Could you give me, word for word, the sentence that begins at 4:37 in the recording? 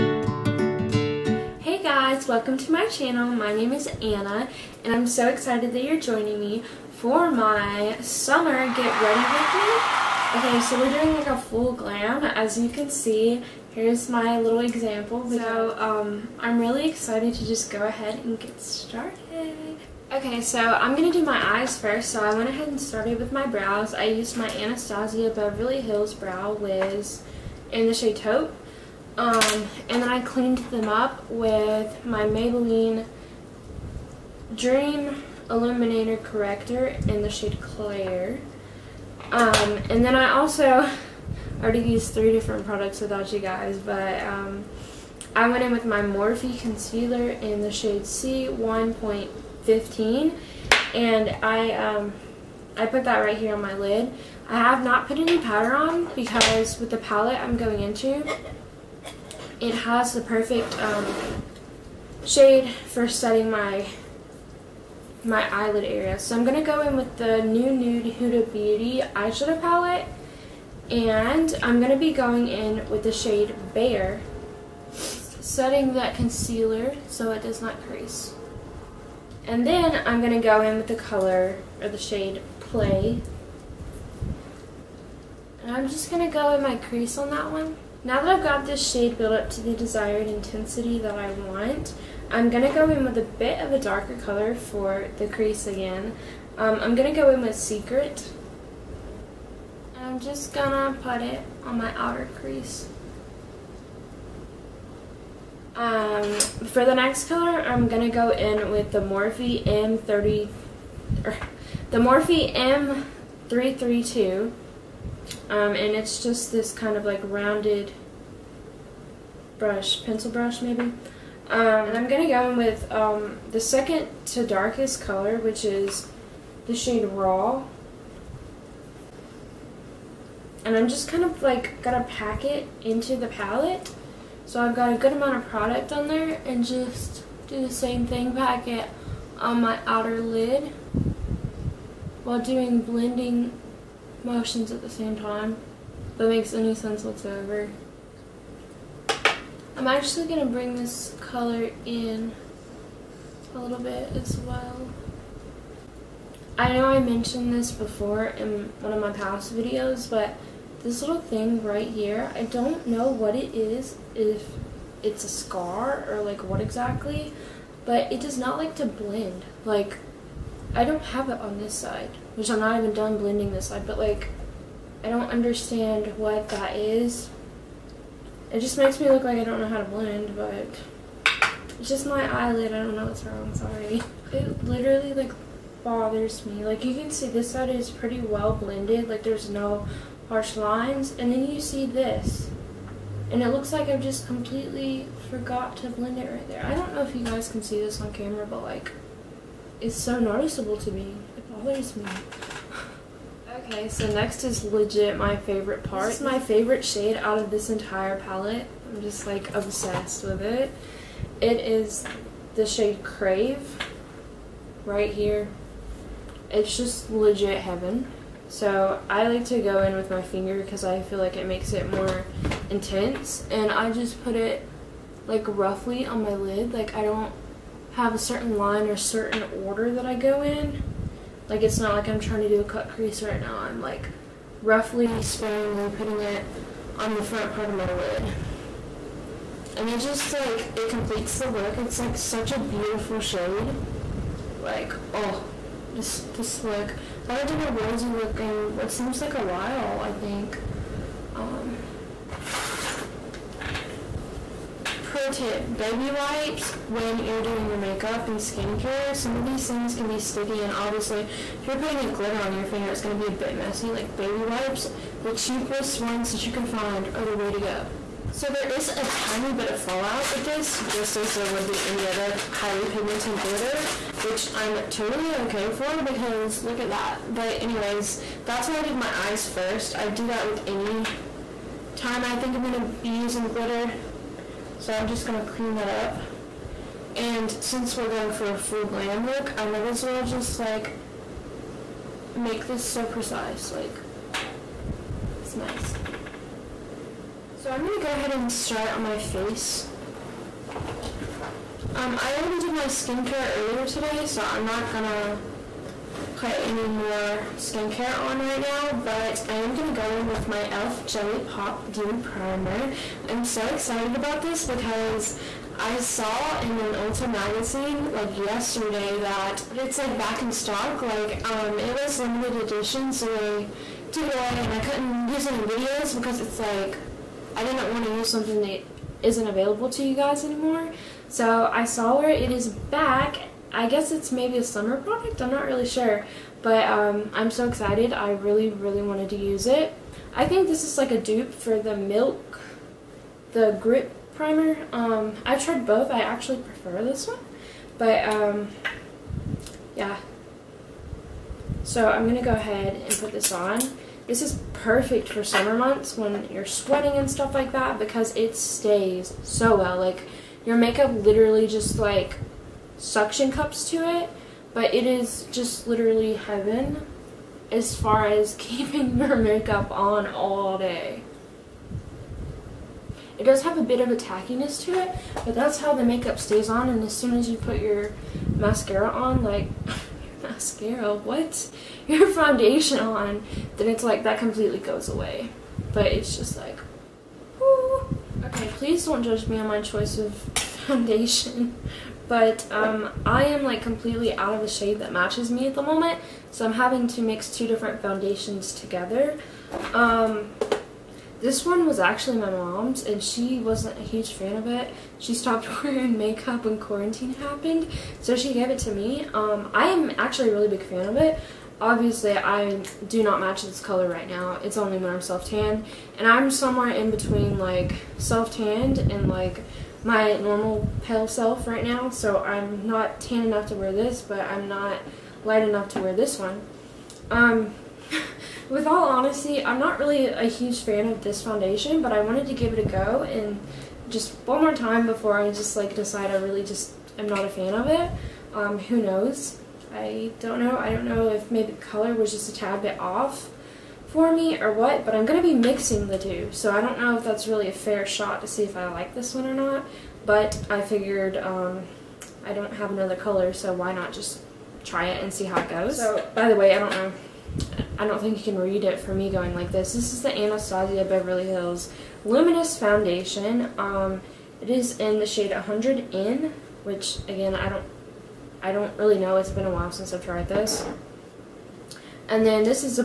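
But anyways, that's why I did my eyes first.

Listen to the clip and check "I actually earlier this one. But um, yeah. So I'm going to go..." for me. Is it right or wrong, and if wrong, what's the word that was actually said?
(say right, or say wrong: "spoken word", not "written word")
wrong: "prefer", not "earlier".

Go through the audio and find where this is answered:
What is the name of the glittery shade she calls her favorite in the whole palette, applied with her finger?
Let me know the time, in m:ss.
3:33.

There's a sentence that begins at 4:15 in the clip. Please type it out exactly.
Pro tip, baby wipes when you're doing your makeup and skincare.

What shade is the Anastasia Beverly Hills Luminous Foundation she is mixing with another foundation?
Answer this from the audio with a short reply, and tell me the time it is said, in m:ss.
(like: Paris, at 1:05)
100N, at 7:45.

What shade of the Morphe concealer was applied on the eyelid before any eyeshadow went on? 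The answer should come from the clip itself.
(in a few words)
C1.15.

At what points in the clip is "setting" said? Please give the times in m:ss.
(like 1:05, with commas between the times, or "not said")
1:03, 1:14.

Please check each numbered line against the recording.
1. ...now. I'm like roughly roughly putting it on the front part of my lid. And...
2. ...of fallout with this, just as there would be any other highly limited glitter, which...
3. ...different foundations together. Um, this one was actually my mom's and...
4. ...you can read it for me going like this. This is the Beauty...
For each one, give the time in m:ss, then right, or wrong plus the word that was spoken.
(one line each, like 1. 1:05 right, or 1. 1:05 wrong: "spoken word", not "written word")
1. 3:53 wrong: "sparingly", not "roughly"
2. 4:29 wrong: "pigmented", not "limited"
3. 6:37 right
4. 7:38 wrong: "Anastasia", not "Beauty".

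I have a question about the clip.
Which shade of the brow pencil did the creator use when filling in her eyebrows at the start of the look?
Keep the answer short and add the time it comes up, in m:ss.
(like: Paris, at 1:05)
Taupe, at 0:28.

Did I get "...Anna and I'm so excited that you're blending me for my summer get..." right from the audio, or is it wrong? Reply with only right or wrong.
wrong.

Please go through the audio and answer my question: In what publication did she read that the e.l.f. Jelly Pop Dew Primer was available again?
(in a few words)
Ulta magazine.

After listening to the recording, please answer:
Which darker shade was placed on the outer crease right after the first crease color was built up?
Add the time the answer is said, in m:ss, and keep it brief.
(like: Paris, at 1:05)
Secret, at 1:37.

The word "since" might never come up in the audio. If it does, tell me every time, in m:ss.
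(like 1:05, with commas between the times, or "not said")
4:47, 7:49.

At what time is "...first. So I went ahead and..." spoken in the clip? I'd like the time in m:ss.
0:21.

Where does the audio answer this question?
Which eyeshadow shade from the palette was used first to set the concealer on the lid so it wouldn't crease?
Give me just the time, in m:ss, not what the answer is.
1:13.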